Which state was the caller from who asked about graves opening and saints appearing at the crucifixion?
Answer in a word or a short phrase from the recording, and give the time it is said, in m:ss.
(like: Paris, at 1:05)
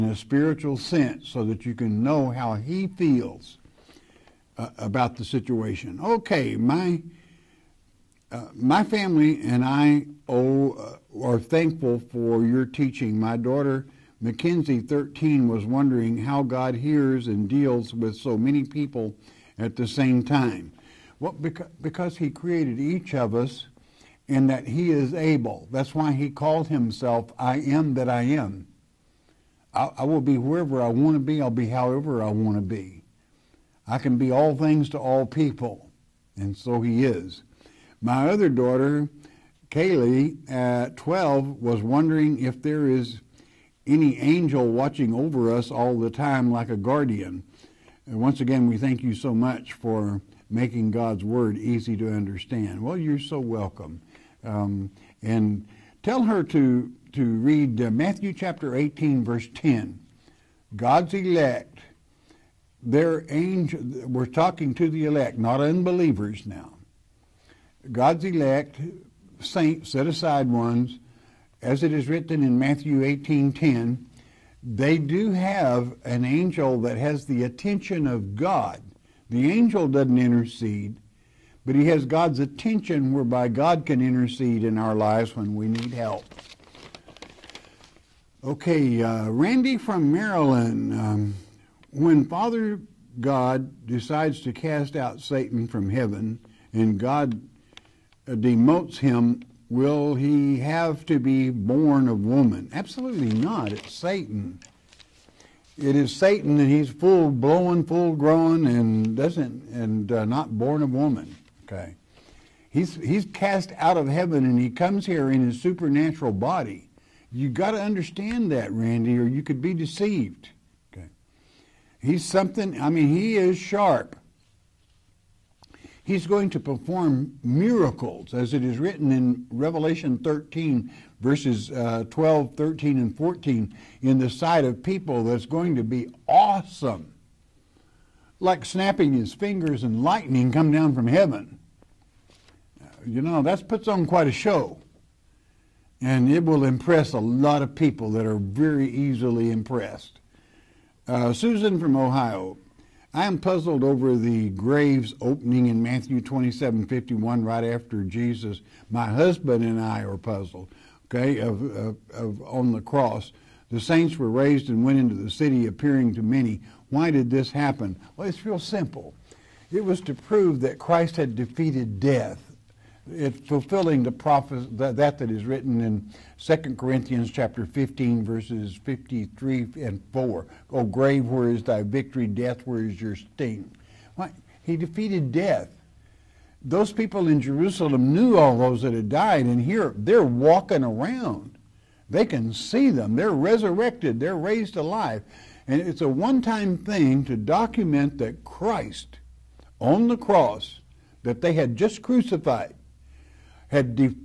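Ohio, at 2:31.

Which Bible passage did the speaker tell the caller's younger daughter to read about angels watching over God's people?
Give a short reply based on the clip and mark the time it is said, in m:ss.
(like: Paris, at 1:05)
Matthew 18:10, at 0:57.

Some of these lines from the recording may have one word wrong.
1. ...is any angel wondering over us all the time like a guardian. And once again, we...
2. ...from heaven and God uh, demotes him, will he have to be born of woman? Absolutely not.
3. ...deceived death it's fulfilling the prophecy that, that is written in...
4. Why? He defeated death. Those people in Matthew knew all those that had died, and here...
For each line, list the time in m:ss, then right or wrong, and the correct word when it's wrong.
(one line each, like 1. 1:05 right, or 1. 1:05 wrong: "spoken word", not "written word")
1. 0:42 wrong: "watching", not "wondering"
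2. 1:35 right
3. 2:51 wrong: "defeated", not "deceived"
4. 3:04 wrong: "Jerusalem", not "Matthew".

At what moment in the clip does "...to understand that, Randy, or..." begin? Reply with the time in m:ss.
1:57.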